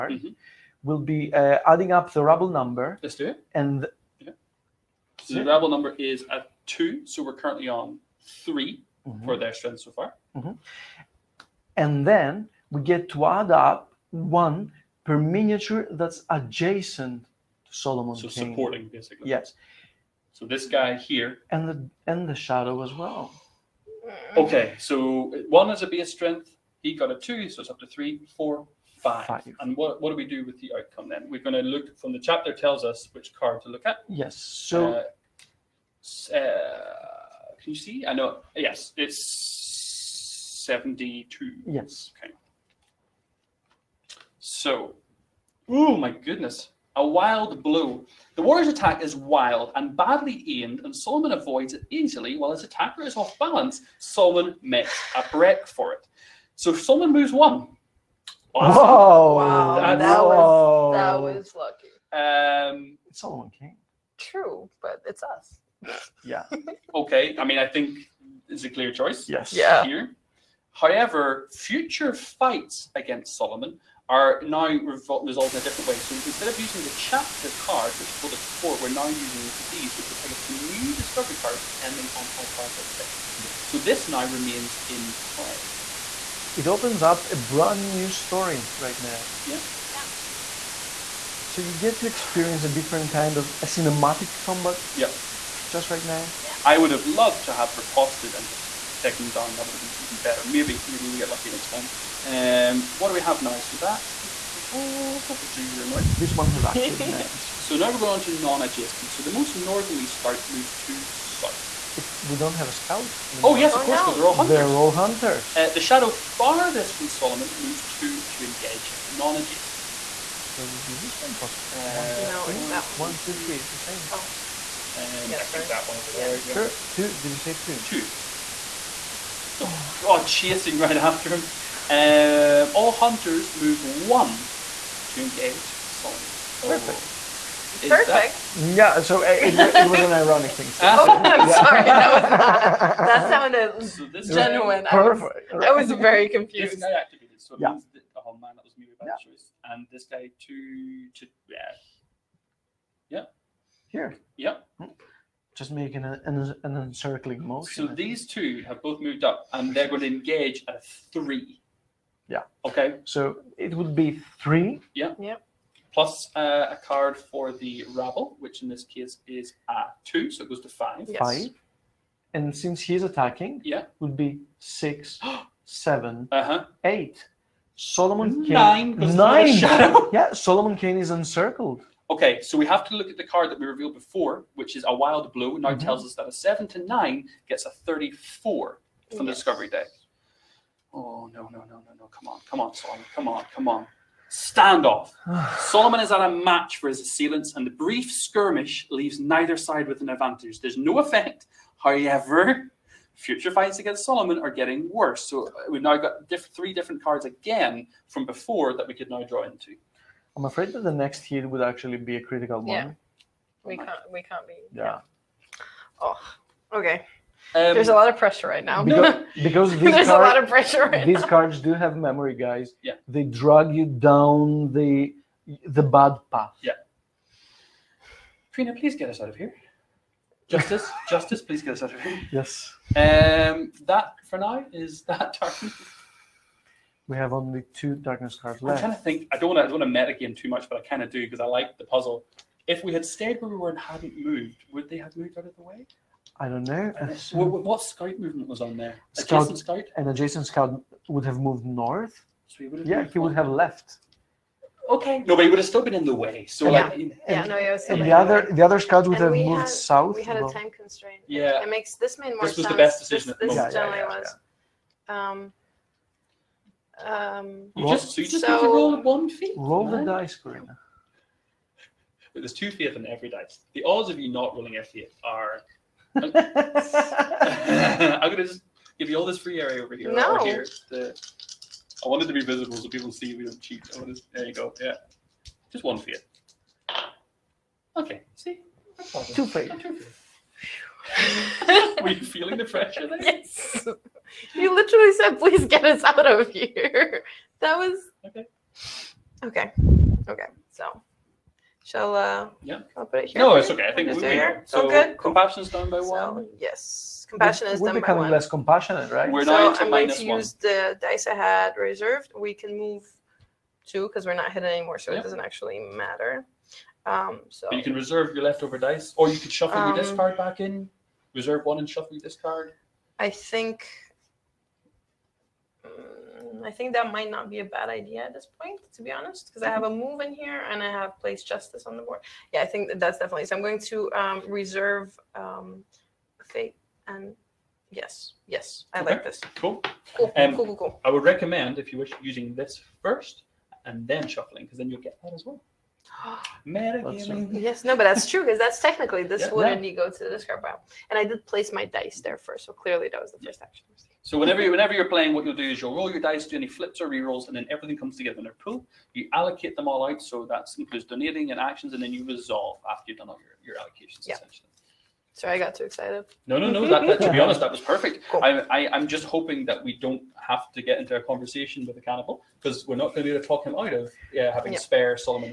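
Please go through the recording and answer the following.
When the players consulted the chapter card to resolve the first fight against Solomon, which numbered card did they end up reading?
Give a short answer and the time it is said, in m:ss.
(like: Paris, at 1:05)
72, at 0:40.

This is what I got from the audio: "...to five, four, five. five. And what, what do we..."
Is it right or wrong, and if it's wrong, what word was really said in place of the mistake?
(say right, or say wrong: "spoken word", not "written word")
wrong: "three", not "five".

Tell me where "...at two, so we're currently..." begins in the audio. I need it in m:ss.
0:06.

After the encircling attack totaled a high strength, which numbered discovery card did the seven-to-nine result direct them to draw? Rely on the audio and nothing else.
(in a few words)
34.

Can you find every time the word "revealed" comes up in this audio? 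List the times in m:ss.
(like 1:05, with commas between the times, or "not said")
3:03.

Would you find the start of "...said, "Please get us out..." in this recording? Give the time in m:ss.
4:55.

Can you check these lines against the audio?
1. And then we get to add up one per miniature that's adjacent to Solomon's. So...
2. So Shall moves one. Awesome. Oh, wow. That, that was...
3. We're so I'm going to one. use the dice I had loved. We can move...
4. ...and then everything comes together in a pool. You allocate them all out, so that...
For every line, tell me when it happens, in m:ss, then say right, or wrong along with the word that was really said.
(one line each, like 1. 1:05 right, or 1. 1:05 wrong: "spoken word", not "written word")
1. 0:11 right
2. 0:56 wrong: "Solomon", not "Shall"
3. 5:09 wrong: "reserved", not "loved"
4. 5:57 right.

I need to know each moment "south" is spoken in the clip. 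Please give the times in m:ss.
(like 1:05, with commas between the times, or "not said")
1:51, 4:19.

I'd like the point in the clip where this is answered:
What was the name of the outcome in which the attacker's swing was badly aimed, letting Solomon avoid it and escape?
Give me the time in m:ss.
0:46.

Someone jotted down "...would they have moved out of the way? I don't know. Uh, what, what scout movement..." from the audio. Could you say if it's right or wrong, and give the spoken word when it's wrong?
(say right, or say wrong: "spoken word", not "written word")
right.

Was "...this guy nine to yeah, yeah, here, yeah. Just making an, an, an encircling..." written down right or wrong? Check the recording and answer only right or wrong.
wrong.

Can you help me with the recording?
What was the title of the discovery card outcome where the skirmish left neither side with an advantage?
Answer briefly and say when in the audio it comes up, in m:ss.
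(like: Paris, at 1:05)
Standoff, at 3:14.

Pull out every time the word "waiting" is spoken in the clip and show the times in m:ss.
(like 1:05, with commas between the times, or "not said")
not said.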